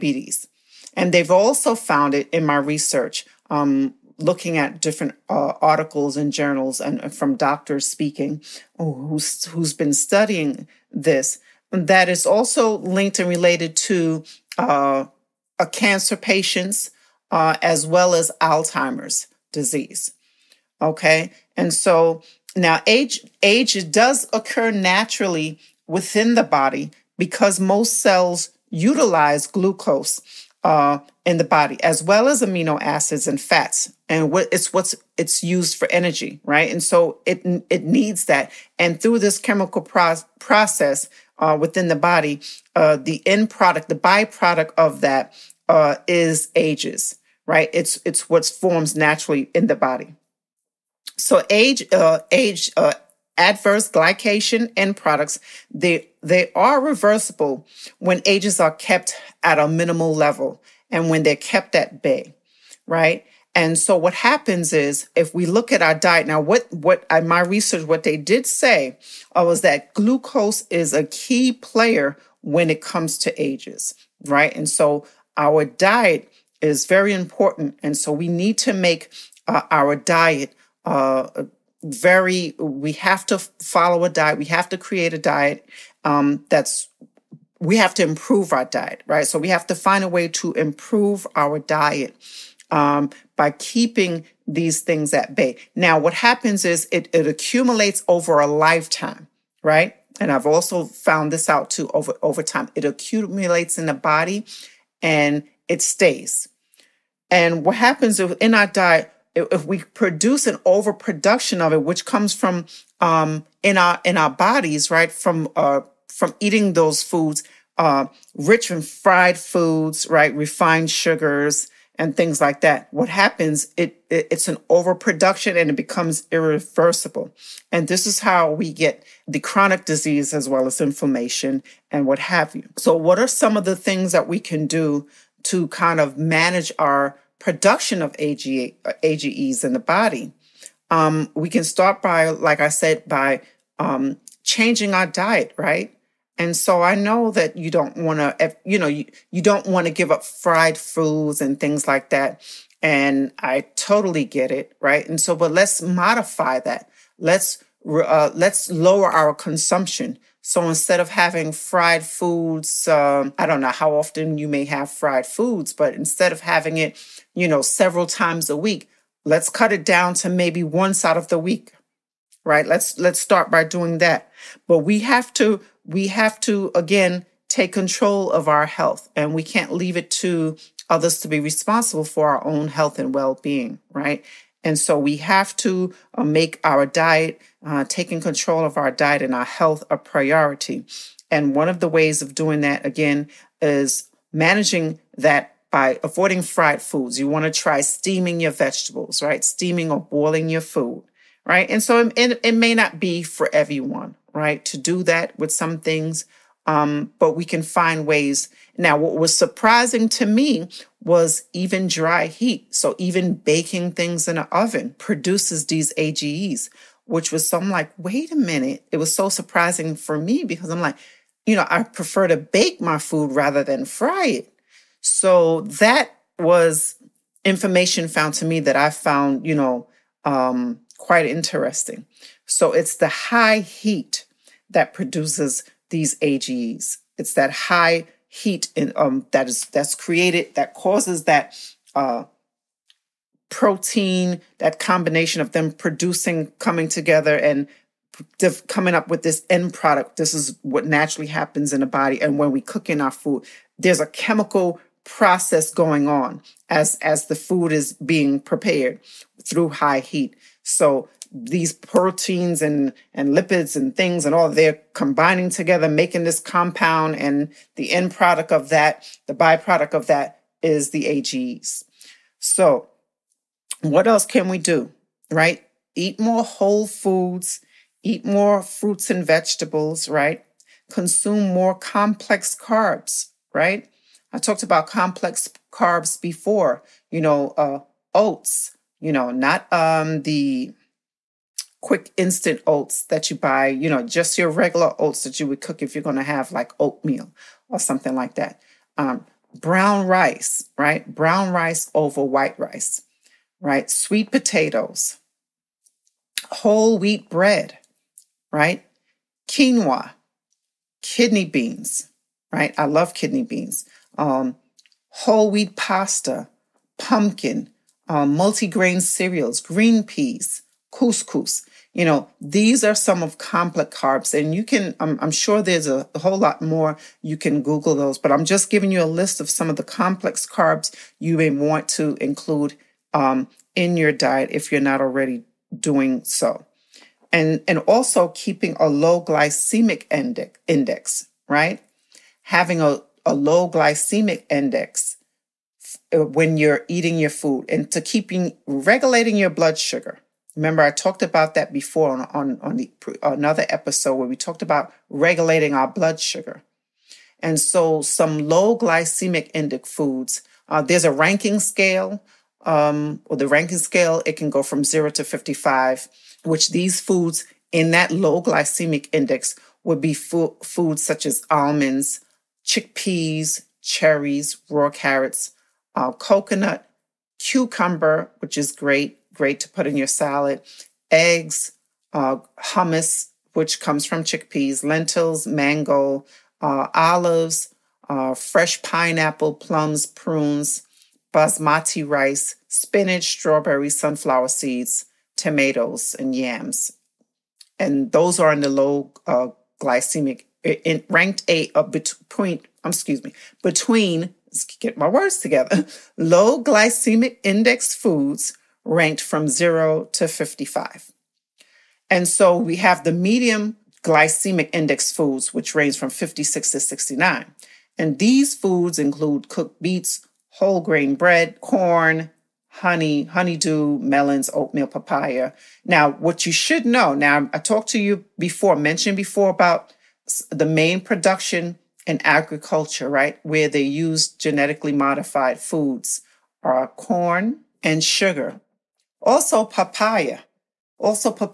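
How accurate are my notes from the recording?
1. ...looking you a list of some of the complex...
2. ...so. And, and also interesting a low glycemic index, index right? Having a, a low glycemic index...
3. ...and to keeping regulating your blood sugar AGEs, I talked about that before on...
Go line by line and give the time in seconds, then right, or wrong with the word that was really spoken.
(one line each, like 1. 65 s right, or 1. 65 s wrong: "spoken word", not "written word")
1. 328 s wrong: "giving", not "looking"
2. 336 s wrong: "keeping", not "interesting"
3. 347 s wrong: "Remember", not "AGEs".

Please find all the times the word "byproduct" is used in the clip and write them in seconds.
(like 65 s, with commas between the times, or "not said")
43 s, 269 s.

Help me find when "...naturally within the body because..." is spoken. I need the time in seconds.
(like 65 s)
24 s.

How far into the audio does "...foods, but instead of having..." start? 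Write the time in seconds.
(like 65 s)
165 s.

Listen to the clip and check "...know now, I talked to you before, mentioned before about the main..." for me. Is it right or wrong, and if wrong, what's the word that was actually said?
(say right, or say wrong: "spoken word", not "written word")
right.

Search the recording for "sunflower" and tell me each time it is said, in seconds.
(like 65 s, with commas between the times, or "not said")
393 s.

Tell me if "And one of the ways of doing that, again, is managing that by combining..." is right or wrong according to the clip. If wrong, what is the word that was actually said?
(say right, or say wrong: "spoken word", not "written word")
wrong: "avoiding", not "combining".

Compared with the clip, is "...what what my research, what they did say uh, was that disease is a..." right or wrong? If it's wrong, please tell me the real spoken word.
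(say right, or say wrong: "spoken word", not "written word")
wrong: "glucose", not "disease".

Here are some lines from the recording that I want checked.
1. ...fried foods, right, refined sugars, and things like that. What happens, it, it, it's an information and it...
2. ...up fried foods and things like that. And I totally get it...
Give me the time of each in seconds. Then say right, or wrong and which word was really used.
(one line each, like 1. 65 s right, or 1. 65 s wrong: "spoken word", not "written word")
1. 118 s wrong: "overproduction", not "information"
2. 150 s right.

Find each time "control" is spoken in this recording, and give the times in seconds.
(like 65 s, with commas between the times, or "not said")
177 s, 188 s.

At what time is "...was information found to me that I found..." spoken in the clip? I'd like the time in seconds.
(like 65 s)
226 s.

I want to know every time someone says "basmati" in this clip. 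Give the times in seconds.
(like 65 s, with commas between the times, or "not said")
391 s.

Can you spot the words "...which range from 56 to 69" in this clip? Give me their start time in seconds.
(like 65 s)
415 s.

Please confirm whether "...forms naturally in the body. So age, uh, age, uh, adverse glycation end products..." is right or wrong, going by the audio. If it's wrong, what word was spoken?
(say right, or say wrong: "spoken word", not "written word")
right.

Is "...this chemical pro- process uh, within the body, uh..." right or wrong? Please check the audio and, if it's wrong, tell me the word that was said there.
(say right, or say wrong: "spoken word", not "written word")
right.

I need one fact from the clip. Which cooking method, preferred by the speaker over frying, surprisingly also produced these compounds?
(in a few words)
Baking.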